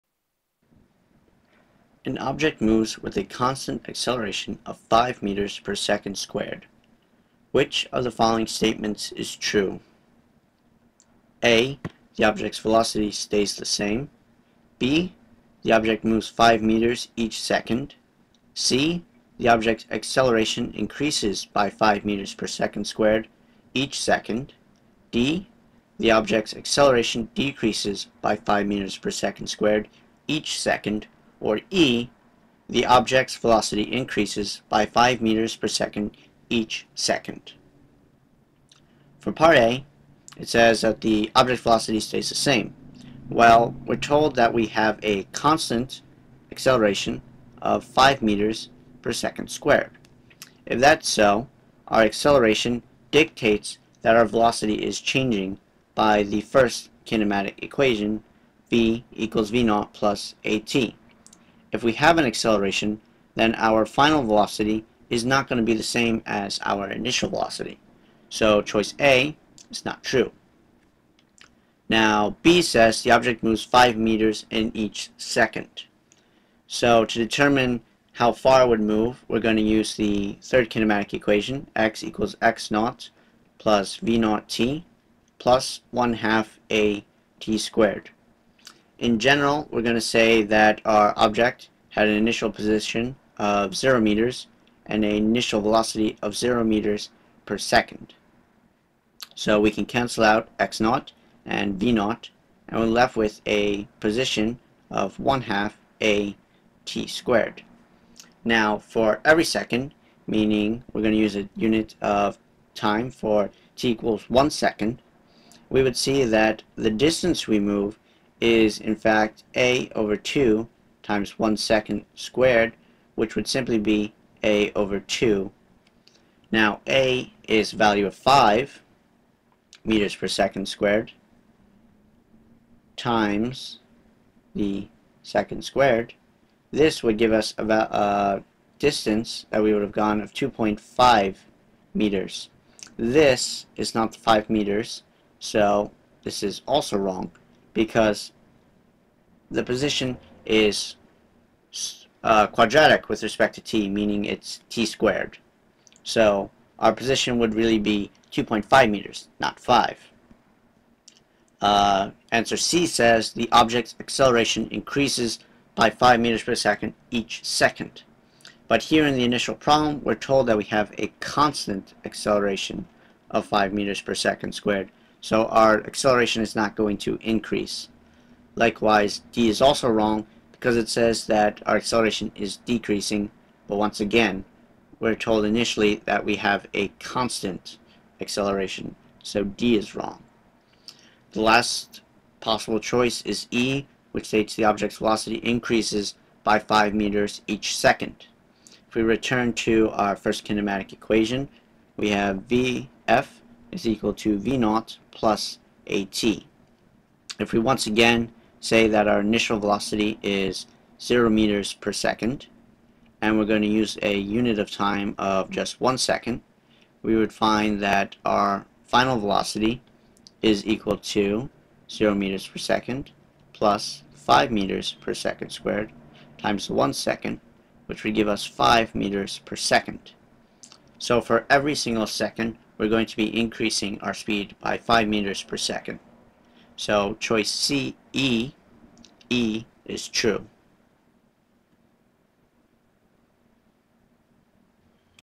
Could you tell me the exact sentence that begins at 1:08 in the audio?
So choice A is not true.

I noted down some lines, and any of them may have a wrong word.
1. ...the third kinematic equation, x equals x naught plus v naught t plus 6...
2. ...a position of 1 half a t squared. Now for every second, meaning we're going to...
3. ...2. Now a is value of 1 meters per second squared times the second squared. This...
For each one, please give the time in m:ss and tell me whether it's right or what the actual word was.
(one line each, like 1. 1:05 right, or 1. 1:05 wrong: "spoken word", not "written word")
1. 1:19 wrong: "1", not "6"
2. 1:43 right
3. 2:04 wrong: "5", not "1".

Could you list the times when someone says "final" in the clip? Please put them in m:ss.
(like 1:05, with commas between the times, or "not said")
1:03, 3:38.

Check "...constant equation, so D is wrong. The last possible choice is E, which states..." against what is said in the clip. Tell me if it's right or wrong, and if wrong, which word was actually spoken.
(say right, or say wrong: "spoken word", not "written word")
wrong: "acceleration", not "equation".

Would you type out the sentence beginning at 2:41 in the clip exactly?
Uh, answer C says the object's acceleration increases by 5 meters per second each second.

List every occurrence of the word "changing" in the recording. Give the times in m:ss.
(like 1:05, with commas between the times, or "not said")
0:55.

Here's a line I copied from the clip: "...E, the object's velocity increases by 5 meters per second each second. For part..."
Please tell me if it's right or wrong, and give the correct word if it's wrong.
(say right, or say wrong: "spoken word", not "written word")
right.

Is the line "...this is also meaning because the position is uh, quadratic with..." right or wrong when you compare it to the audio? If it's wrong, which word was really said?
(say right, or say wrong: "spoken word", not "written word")
wrong: "wrong", not "meaning".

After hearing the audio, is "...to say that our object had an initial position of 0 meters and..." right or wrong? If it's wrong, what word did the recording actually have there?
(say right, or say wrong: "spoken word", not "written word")
right.